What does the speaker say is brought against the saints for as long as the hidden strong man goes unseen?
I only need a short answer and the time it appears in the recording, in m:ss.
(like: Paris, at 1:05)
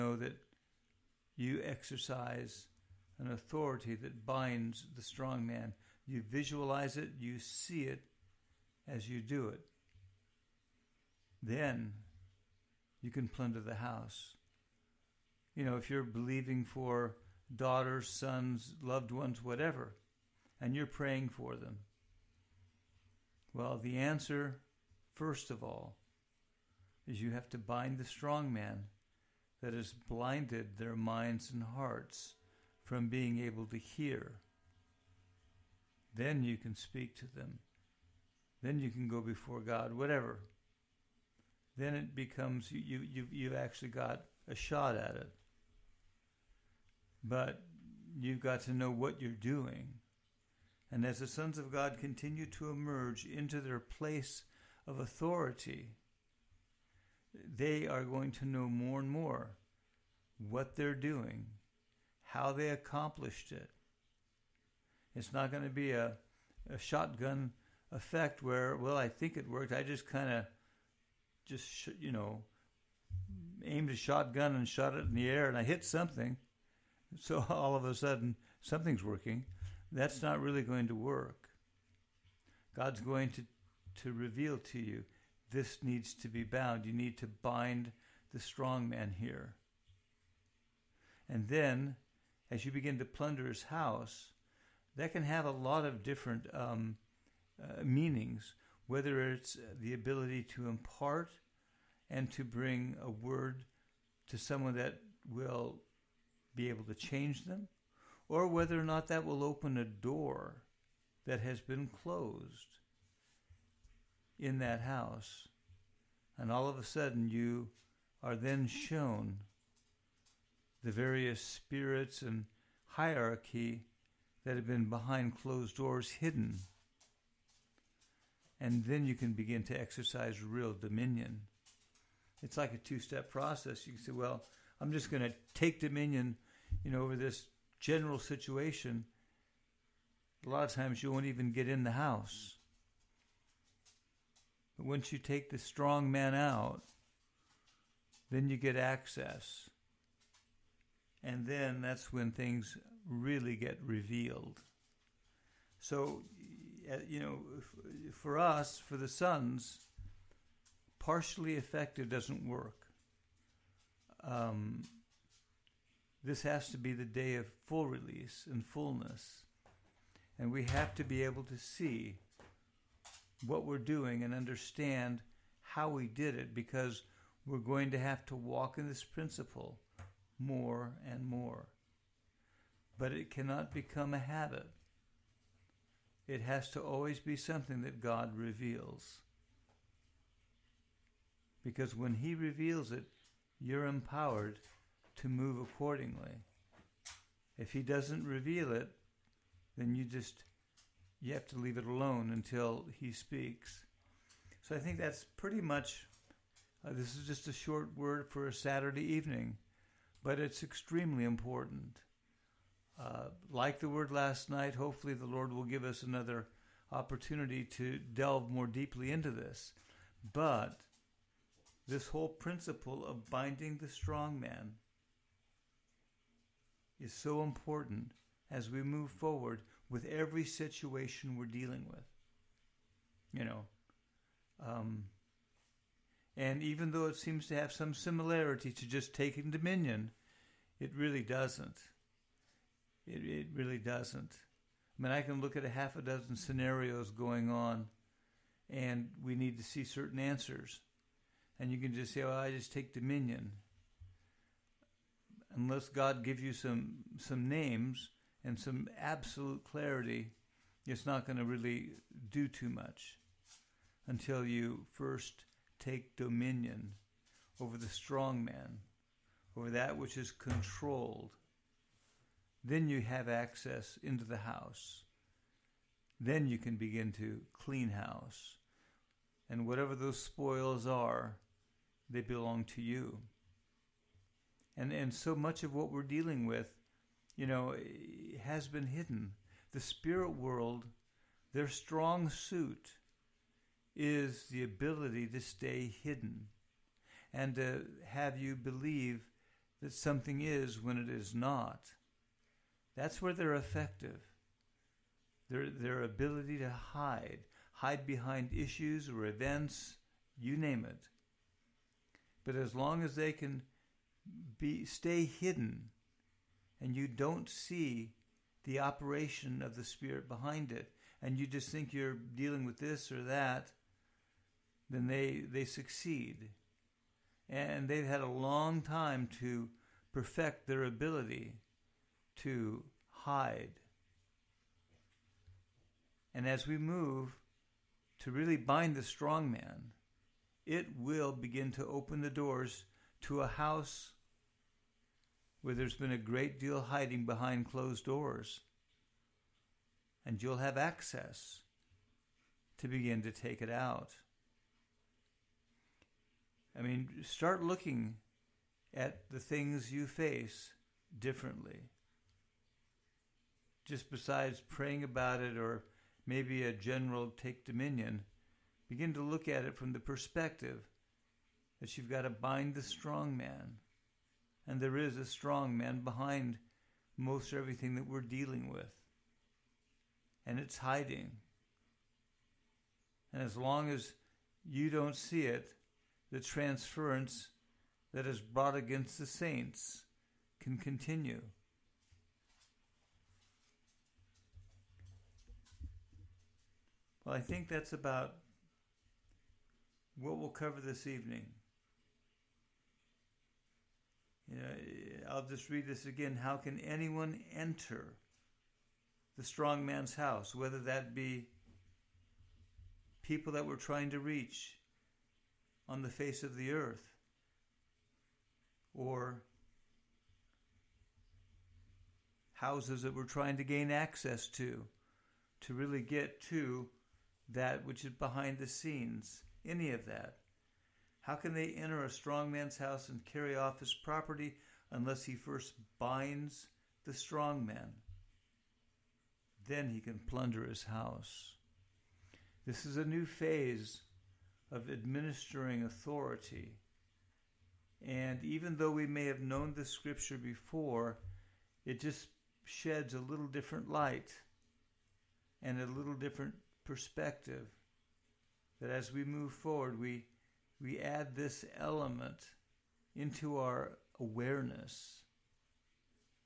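Transference, at 6:26.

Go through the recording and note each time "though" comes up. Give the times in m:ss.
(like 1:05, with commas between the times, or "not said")
3:56, 7:28.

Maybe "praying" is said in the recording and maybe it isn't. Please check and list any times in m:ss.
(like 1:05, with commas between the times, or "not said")
0:20, 6:04.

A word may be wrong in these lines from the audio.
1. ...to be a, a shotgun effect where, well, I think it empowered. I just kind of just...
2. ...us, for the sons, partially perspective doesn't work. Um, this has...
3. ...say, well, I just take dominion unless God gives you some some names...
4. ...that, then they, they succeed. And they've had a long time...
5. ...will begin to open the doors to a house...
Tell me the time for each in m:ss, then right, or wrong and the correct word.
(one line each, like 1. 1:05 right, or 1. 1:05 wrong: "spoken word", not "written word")
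1. 1:05 wrong: "worked", not "empowered"
2. 2:38 wrong: "effective", not "perspective"
3. 4:12 right
4. 5:23 right
5. 5:40 right.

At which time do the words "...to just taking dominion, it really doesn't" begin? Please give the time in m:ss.
3:58.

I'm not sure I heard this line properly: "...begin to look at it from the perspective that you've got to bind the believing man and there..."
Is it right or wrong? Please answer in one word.
wrong.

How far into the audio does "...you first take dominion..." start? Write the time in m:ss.
4:24.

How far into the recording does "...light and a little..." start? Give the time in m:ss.
7:33.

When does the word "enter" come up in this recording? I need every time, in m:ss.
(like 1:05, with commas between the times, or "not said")
6:47, 7:11.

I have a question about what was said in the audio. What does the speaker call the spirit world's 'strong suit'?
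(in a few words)
Ability to stay hidden.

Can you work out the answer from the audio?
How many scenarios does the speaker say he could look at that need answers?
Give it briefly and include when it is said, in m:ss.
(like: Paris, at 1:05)
Half a dozen, at 4:05.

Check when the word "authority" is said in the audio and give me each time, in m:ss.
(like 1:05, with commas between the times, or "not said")
0:03, 0:54, 7:25.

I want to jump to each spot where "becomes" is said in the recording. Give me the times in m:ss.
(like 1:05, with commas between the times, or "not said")
0:42, 3:03.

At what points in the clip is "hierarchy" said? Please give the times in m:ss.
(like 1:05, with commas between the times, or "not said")
2:02.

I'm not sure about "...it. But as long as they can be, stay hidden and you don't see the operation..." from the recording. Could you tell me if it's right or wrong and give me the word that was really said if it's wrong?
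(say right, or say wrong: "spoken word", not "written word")
right.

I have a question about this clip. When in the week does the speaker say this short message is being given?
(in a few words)
Saturday evening.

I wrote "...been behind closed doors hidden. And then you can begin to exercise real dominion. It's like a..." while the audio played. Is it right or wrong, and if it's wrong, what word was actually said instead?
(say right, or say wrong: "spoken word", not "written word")
right.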